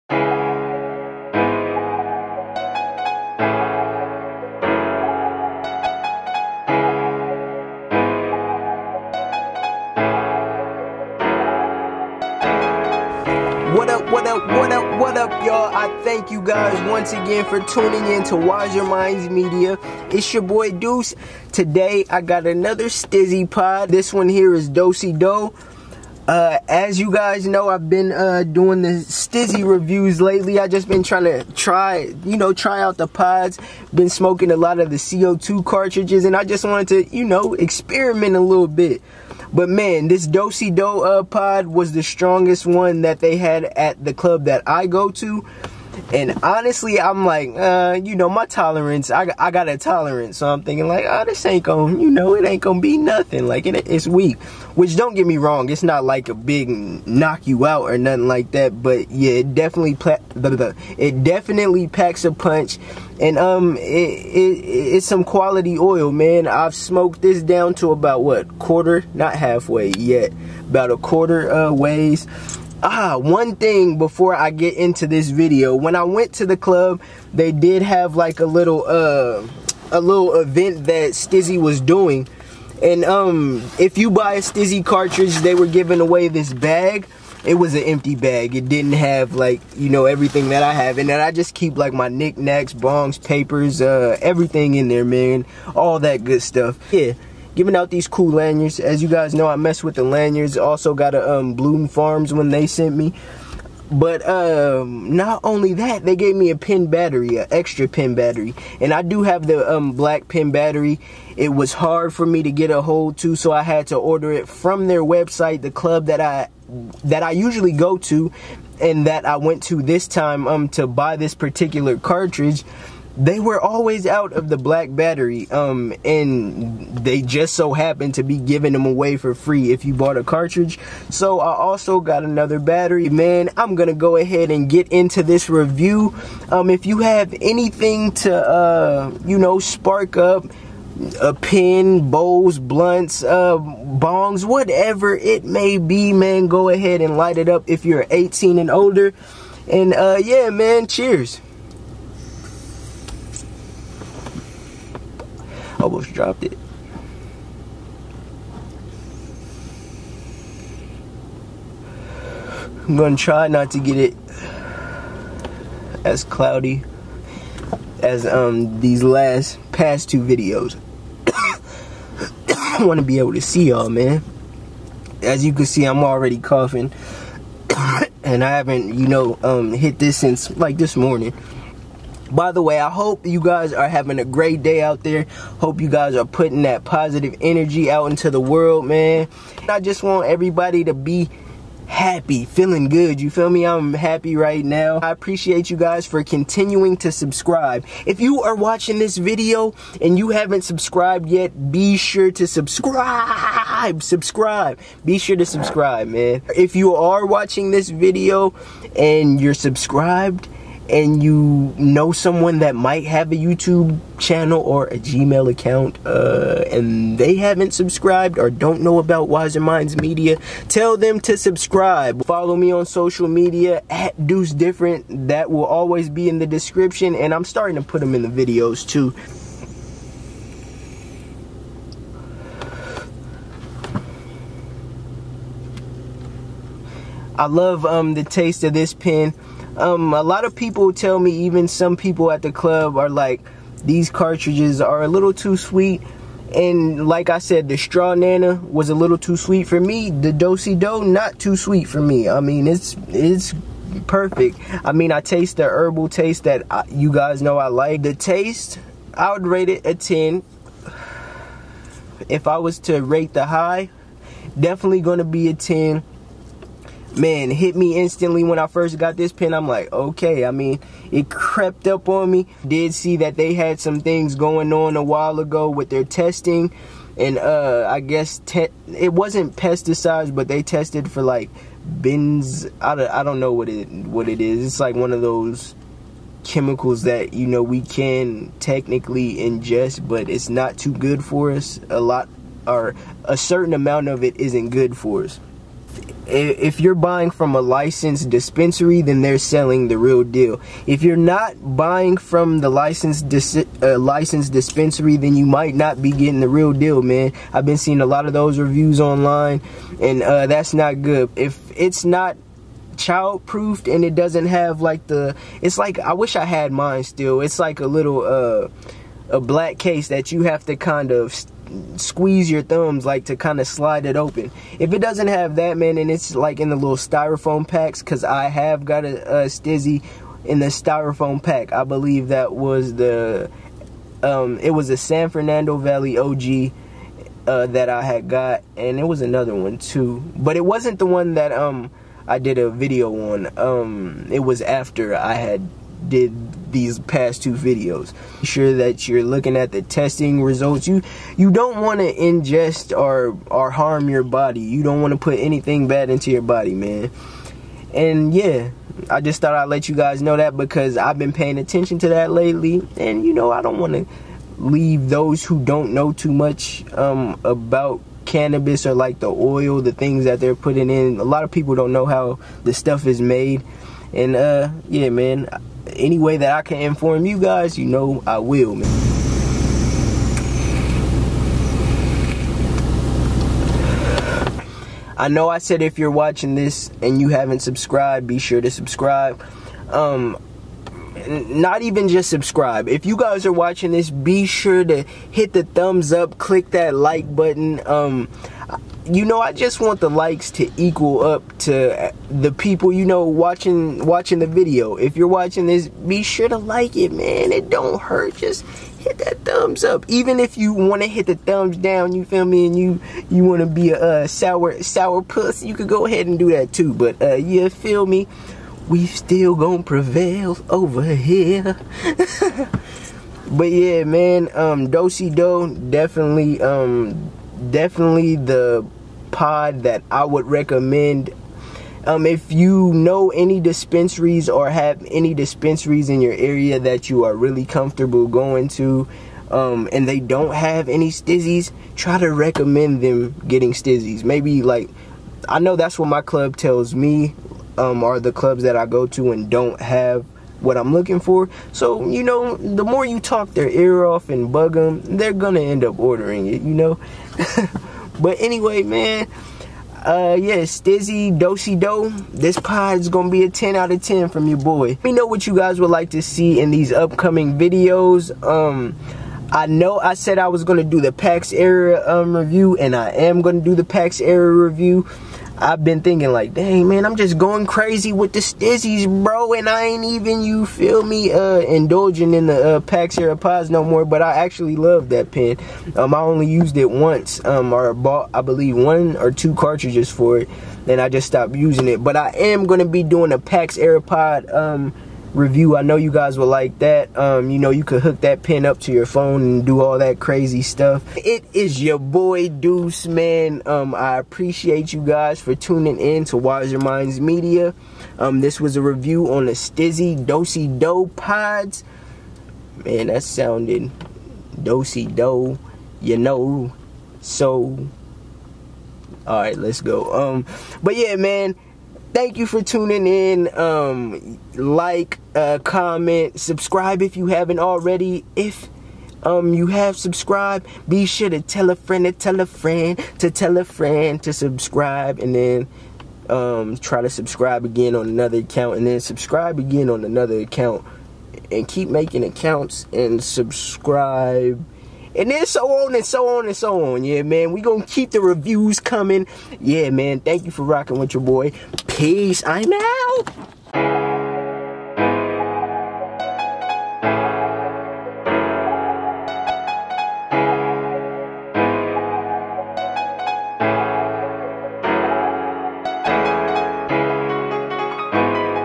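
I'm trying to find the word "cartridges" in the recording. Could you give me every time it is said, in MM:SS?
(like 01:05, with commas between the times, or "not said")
00:35, 01:24, 02:01, 02:10, 04:04, 08:09.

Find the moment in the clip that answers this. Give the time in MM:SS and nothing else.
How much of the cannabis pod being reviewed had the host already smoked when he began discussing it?
01:10.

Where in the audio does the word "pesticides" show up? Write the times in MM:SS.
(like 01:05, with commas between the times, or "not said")
04:39.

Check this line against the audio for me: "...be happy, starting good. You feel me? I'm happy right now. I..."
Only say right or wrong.
wrong.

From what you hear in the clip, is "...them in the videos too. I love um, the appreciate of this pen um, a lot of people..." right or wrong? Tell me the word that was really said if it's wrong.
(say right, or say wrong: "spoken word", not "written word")
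wrong: "taste", not "appreciate".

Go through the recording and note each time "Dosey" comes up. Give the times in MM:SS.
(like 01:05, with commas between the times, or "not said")
00:24, 00:40, 08:30, 08:34.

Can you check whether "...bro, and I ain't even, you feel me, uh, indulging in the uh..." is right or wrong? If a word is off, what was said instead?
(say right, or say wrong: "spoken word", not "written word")
right.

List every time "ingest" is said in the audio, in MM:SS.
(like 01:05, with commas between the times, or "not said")
04:49, 05:52.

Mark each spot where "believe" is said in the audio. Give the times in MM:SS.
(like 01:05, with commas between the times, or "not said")
05:31, 08:08.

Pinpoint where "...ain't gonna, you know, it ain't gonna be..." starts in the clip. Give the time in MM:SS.
00:51.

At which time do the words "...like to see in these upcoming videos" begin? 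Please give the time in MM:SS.
07:45.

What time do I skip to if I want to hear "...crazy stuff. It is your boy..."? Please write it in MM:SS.
08:20.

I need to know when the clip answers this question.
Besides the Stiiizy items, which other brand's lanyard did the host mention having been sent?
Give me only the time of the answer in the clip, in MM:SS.
01:41.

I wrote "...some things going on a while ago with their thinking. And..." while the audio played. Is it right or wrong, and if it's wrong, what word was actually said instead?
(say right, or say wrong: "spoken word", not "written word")
wrong: "testing", not "thinking".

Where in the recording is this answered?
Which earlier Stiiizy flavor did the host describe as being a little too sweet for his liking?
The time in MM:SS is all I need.
04:07.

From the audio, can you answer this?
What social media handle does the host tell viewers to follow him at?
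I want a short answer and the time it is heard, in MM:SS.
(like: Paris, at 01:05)
Deuce Different, at 03:44.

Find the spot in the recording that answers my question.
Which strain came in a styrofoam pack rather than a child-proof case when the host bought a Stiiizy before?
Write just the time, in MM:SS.
05:34.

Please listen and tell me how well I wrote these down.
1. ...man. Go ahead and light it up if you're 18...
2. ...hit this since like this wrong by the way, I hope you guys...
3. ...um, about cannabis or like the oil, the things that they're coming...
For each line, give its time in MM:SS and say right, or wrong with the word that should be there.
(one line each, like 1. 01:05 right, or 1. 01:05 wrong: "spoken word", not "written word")
1. 02:26 right
2. 02:59 wrong: "morning", not "wrong"
3. 06:06 wrong: "putting", not "coming".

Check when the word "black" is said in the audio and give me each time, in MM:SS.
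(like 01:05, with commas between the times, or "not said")
01:49, 02:04, 05:19.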